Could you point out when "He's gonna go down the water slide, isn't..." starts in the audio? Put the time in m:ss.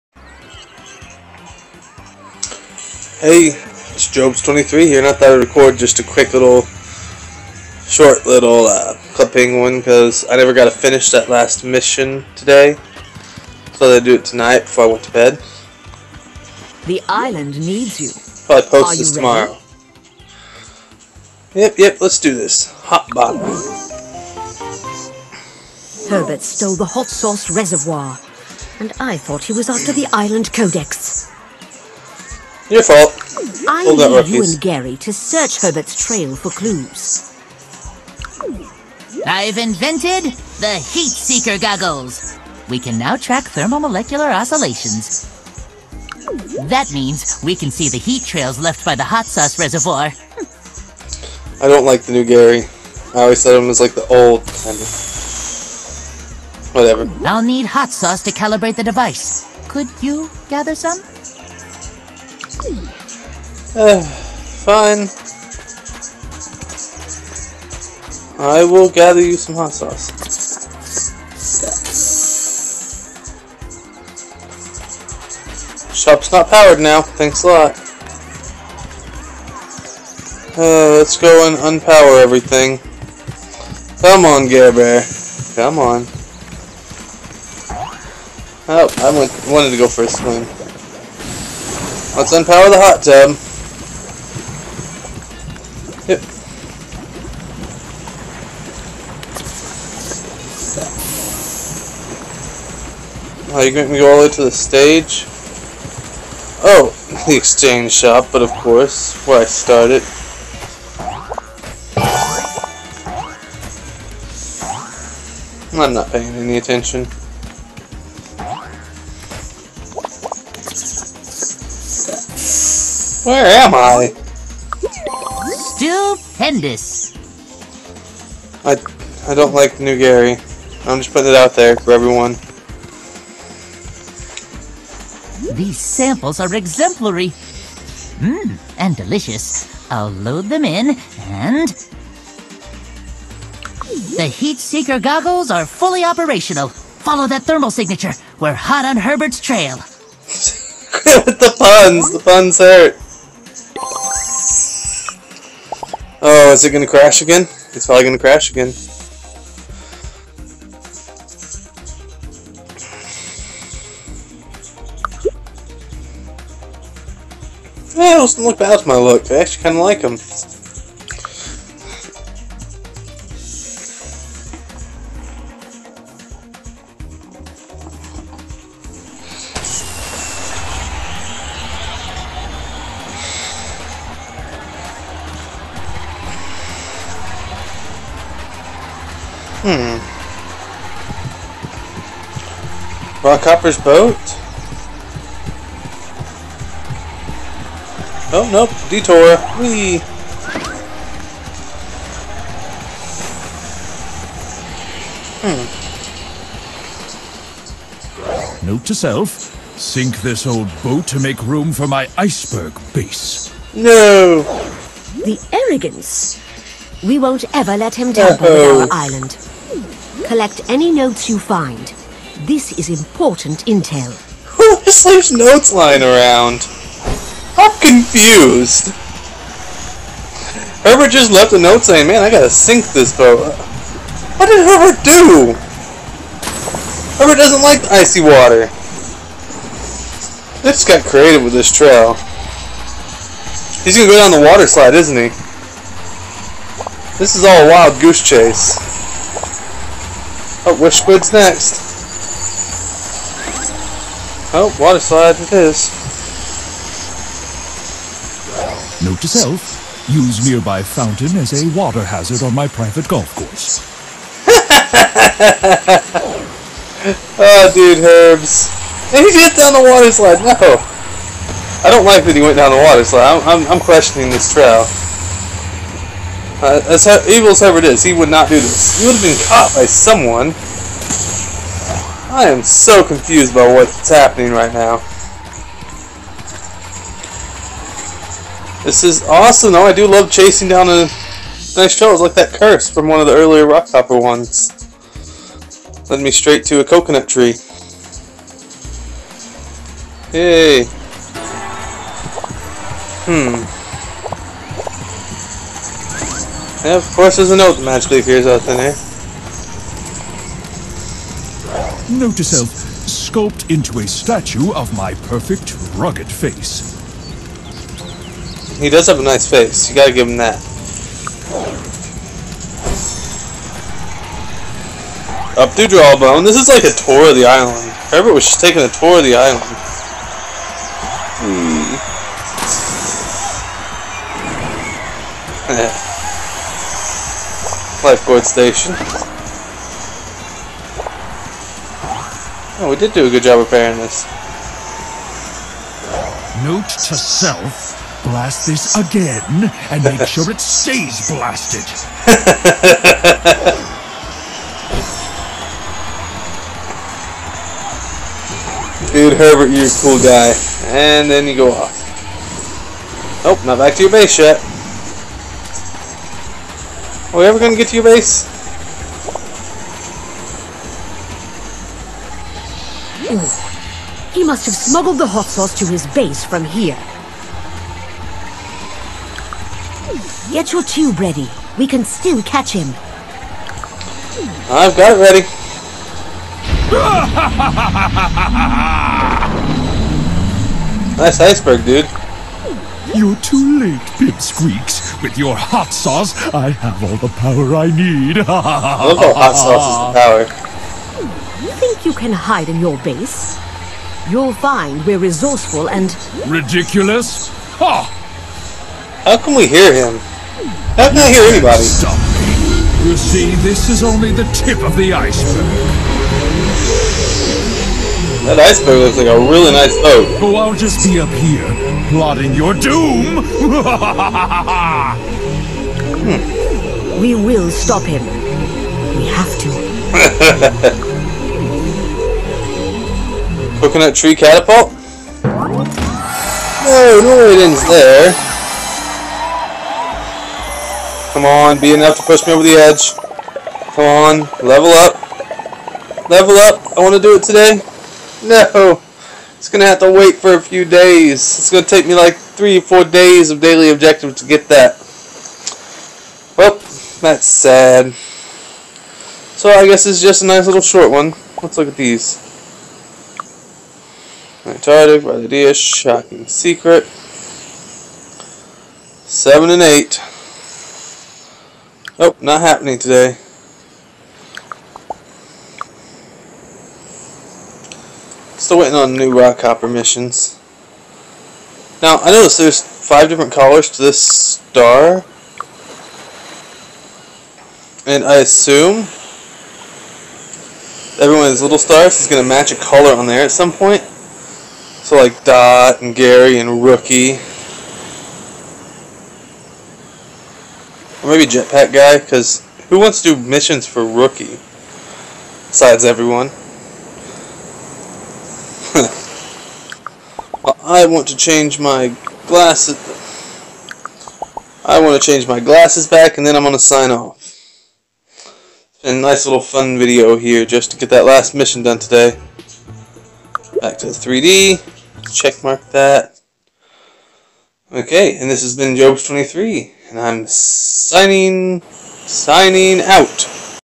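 4:03.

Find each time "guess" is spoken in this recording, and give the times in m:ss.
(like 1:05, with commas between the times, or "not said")
7:39.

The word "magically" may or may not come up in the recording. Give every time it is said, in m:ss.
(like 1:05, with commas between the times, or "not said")
5:07.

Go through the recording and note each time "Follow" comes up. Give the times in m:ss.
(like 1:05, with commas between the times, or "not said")
2:26.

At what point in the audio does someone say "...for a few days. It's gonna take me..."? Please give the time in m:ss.
7:30.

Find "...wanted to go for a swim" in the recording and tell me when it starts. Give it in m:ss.
1:29.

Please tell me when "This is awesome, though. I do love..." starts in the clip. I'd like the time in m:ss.
4:48.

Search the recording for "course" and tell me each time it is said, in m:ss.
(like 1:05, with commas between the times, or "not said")
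1:48, 4:23, 5:07.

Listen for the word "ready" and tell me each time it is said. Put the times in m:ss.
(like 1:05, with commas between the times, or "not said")
6:21, 6:25.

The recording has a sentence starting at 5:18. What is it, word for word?
He does have a nice face, you gotta give him that.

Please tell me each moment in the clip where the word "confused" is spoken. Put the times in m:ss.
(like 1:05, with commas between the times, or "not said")
3:47, 4:43.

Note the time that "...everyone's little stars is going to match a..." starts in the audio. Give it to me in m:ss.
8:11.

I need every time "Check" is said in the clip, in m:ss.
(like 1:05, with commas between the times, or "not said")
8:45.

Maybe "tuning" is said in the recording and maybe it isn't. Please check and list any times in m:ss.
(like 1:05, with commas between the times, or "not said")
not said.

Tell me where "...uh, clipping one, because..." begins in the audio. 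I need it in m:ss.
0:08.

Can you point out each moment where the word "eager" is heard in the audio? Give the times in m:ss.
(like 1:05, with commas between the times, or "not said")
not said.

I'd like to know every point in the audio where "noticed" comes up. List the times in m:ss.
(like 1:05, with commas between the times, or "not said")
8:02.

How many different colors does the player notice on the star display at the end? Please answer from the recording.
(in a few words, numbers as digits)
5.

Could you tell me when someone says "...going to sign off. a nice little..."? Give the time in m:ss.
8:36.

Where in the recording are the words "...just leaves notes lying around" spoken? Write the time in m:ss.
3:44.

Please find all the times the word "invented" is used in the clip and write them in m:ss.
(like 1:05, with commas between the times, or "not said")
0:39.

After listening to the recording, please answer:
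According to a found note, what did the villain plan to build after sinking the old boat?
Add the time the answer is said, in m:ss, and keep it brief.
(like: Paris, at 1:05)
iceberg base, at 3:32.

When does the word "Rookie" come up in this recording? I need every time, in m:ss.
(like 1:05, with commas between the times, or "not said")
8:16, 8:24.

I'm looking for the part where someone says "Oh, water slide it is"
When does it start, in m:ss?
4:14.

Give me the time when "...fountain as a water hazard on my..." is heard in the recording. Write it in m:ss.
4:20.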